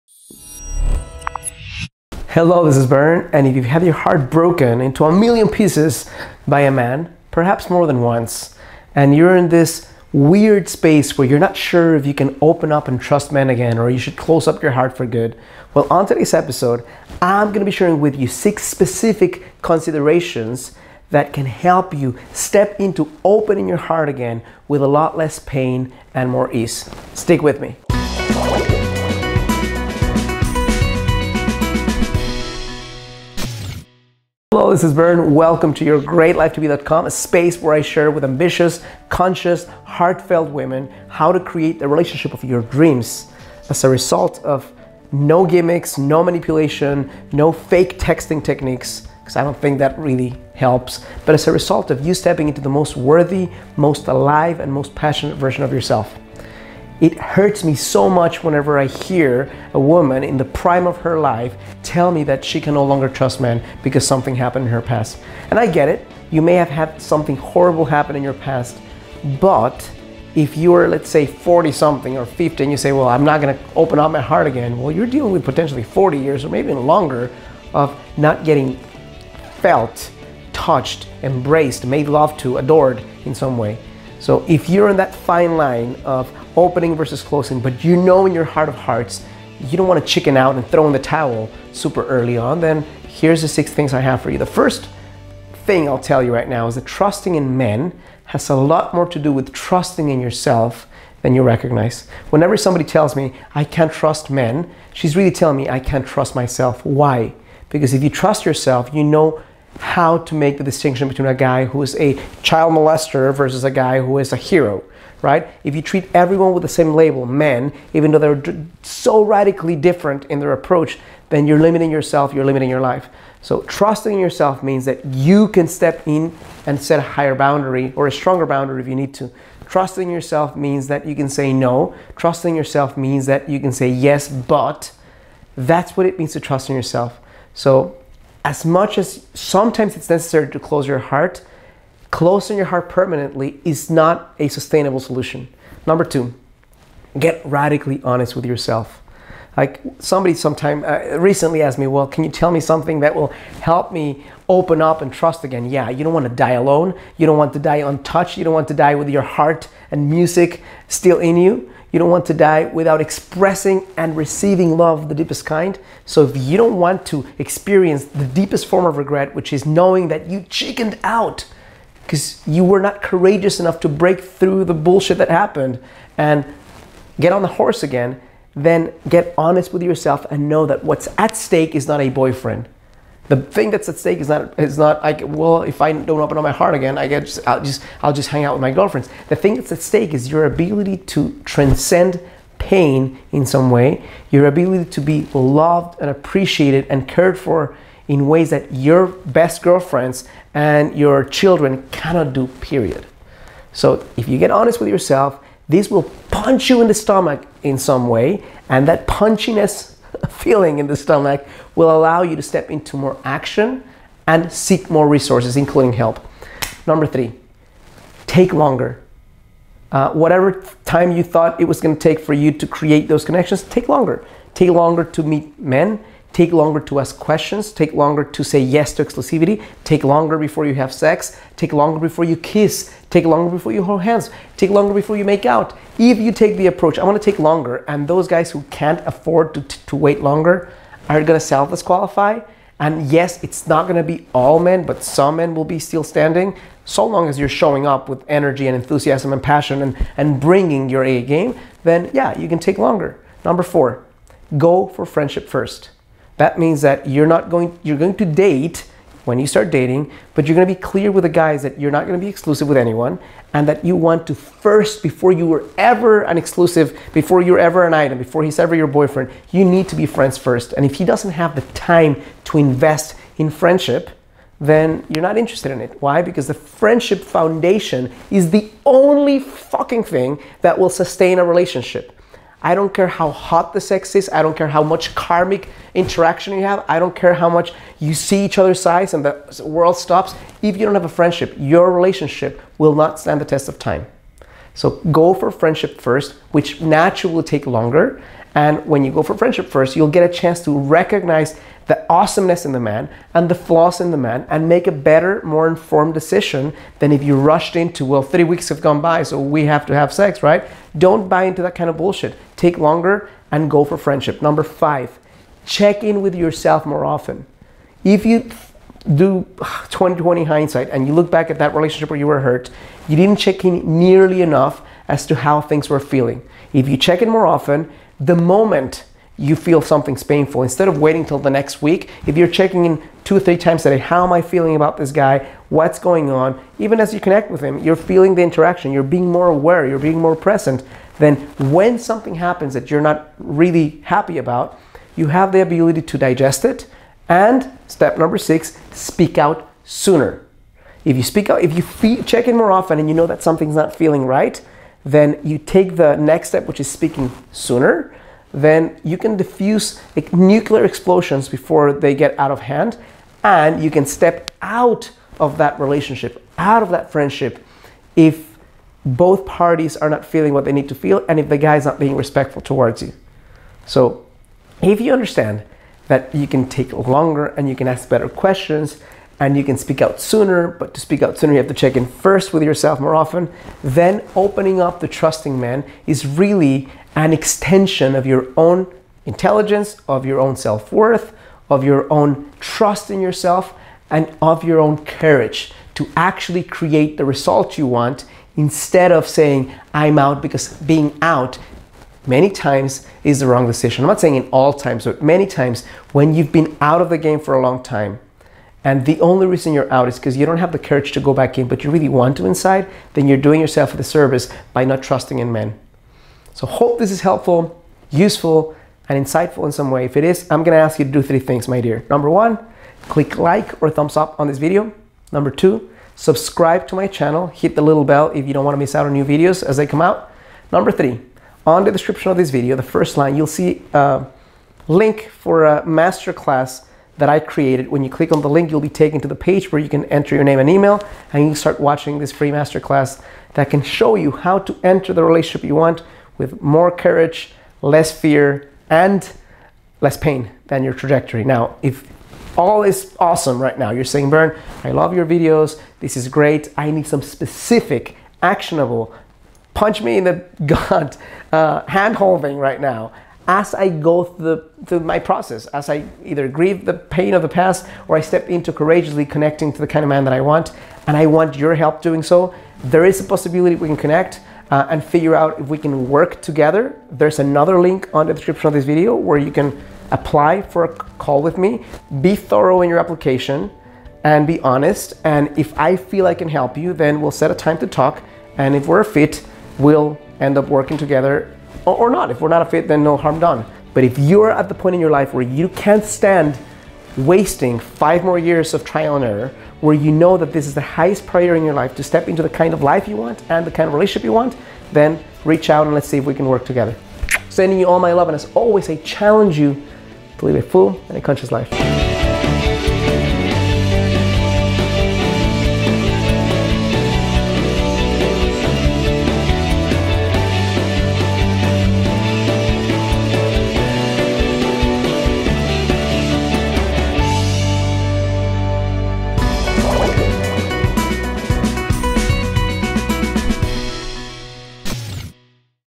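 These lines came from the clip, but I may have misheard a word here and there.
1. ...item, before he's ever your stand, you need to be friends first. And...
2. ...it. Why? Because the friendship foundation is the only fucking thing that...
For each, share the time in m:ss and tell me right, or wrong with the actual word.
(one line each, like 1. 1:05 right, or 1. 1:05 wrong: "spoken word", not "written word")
1. 4:27 wrong: "boyfriend", not "stand"
2. 4:35 right.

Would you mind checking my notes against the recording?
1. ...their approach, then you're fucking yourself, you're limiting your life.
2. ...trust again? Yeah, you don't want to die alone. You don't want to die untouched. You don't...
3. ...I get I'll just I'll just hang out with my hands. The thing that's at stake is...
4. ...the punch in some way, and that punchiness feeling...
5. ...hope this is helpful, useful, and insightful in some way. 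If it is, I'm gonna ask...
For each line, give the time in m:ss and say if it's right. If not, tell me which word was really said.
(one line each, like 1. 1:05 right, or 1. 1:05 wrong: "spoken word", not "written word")
1. 2:00 wrong: "limiting", not "fucking"
2. 2:35 right
3. 3:06 wrong: "girlfriends", not "hands"
4. 3:26 wrong: "stomach", not "punch"
5. 6:56 right.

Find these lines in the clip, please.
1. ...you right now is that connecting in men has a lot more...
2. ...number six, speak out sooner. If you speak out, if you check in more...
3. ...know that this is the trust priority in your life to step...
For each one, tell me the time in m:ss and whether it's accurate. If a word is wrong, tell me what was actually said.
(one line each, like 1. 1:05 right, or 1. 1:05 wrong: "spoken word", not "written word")
1. 1:36 wrong: "trusting", not "connecting"
2. 5:48 right
3. 8:20 wrong: "highest", not "trust".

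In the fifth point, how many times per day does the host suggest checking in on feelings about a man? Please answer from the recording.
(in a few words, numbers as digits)
2 or 3.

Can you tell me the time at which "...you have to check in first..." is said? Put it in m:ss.
6:21.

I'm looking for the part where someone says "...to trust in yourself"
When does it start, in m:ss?
2:16.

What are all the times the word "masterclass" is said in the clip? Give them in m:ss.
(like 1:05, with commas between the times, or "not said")
7:15, 7:22.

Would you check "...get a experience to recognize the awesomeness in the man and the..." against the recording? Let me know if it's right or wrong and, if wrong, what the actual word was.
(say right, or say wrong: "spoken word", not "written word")
wrong: "chance", not "experience".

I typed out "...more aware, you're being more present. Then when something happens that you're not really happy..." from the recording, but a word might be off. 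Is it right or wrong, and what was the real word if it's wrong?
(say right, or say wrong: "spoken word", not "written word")
right.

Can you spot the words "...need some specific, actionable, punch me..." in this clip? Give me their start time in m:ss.
7:36.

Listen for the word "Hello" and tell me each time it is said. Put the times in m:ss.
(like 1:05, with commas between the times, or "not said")
0:02, 0:34.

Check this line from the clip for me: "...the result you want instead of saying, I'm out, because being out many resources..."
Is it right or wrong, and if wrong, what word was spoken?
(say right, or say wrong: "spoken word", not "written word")
wrong: "times", not "resources".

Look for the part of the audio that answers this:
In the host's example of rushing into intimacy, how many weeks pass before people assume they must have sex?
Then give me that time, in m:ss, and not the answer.
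5:08.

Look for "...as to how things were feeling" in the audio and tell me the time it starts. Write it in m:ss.
5:25.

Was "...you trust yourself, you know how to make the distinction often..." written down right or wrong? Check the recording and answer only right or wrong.
wrong.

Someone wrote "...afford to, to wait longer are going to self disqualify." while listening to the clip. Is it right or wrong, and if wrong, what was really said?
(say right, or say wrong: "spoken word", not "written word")
right.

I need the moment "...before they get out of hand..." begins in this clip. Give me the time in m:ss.
6:01.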